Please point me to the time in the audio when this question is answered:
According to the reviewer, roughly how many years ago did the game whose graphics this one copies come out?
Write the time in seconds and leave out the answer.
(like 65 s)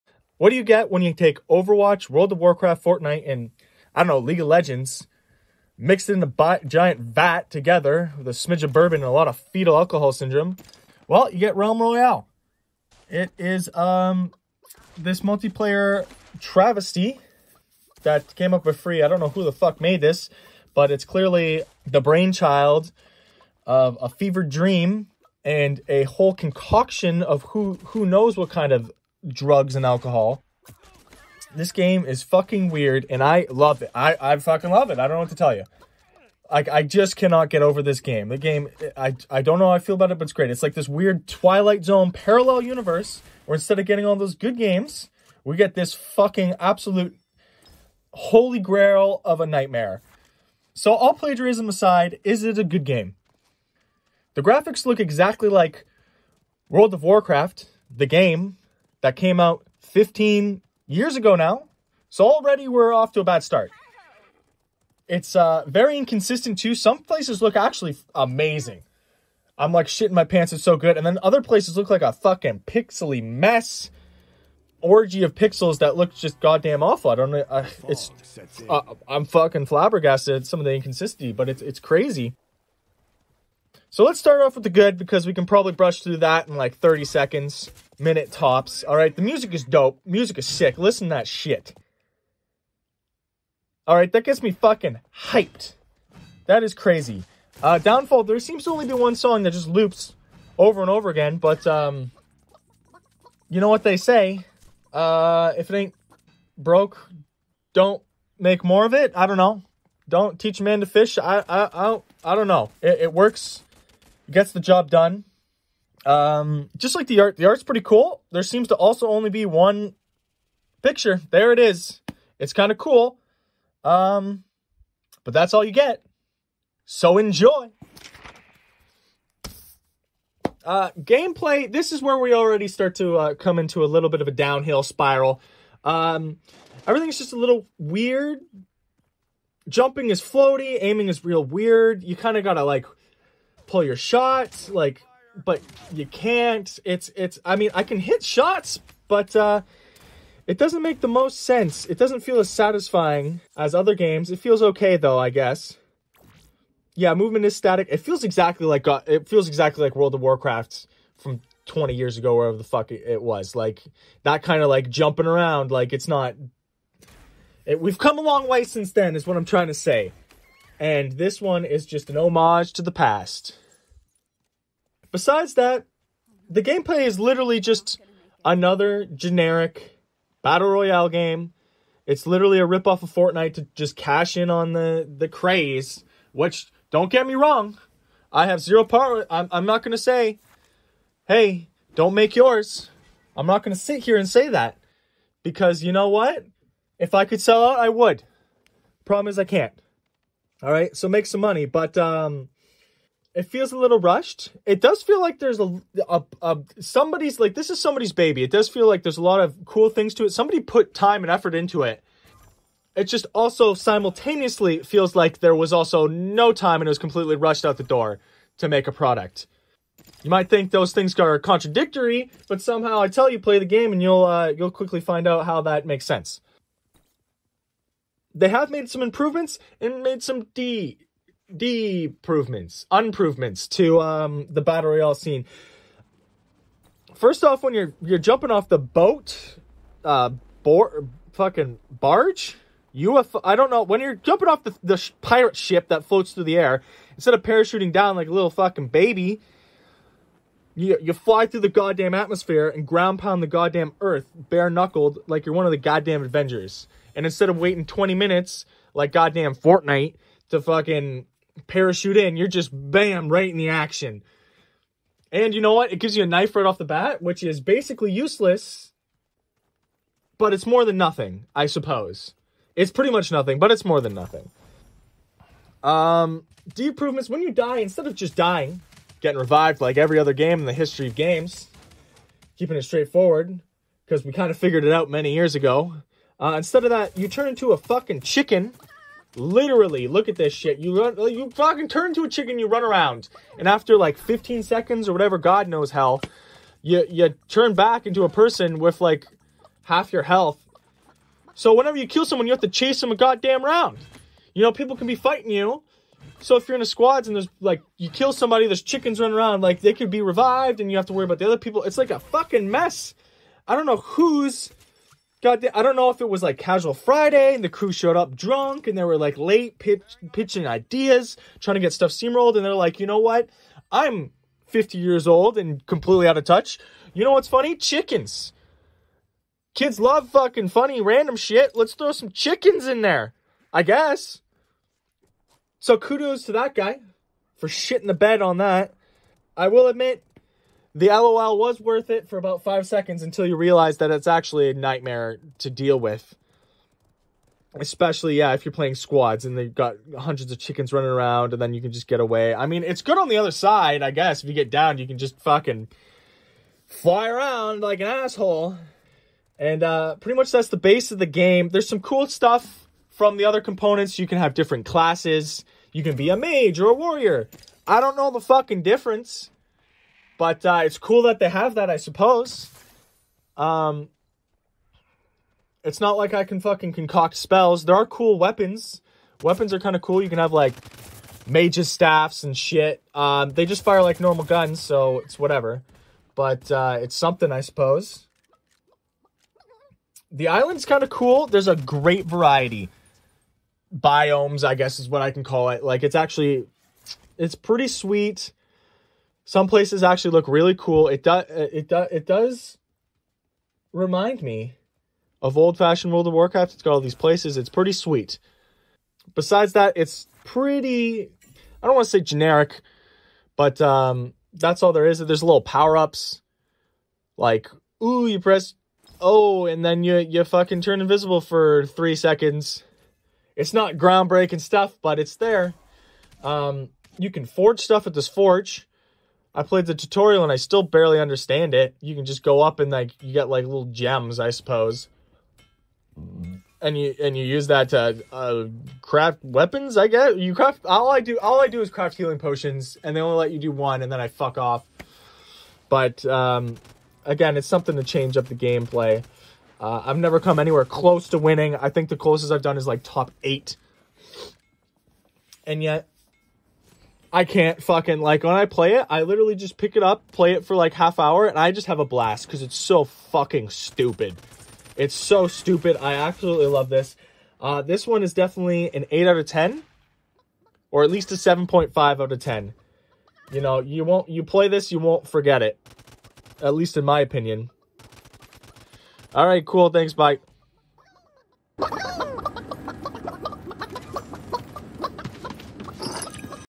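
59 s.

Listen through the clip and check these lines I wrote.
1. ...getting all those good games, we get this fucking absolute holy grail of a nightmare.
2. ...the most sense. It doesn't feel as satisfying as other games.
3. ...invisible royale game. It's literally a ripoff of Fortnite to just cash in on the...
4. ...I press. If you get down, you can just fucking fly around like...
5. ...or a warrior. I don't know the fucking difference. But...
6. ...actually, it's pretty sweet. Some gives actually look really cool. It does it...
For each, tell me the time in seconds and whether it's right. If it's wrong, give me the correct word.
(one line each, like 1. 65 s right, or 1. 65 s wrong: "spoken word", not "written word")
1. 43 s right
2. 151 s right
3. 180 s wrong: "battle", not "invisible"
4. 354 s wrong: "guess", not "press"
5. 366 s right
6. 396 s wrong: "places", not "gives".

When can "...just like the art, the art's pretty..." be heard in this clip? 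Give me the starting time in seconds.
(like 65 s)
116 s.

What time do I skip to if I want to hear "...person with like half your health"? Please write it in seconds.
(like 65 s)
298 s.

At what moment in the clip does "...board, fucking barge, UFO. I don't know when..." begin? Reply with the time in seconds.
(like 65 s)
240 s.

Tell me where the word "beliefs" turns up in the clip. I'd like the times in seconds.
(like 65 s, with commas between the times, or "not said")
not said.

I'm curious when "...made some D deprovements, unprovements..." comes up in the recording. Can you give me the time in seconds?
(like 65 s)
230 s.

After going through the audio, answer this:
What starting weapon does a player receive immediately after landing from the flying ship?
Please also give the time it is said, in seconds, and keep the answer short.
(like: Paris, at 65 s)
knife, at 266 s.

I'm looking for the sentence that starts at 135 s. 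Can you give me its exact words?
Um, everything's just a little weird.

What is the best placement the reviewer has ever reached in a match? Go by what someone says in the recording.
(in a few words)
top 8.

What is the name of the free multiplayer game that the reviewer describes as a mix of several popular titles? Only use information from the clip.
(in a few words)
Realm Royale.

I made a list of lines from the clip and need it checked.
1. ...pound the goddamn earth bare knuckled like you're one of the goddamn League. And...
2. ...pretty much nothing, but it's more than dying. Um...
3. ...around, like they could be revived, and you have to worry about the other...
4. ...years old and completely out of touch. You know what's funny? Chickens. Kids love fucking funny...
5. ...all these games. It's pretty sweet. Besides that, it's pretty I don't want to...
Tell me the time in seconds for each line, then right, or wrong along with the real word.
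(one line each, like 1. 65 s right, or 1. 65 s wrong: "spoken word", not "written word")
1. 253 s wrong: "Avengers", not "League"
2. 272 s wrong: "nothing", not "dying"
3. 309 s right
4. 324 s right
5. 406 s wrong: "places", not "games".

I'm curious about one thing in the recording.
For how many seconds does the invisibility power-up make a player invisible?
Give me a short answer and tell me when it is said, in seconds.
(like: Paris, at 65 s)
3, at 421 s.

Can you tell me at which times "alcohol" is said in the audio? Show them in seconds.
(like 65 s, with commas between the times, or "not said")
9 s, 29 s.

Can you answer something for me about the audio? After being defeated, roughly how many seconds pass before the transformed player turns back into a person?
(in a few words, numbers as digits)
15.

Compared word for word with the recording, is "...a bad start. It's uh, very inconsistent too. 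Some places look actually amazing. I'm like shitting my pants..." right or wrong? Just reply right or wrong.
right.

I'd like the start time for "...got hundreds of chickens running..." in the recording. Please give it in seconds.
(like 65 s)
349 s.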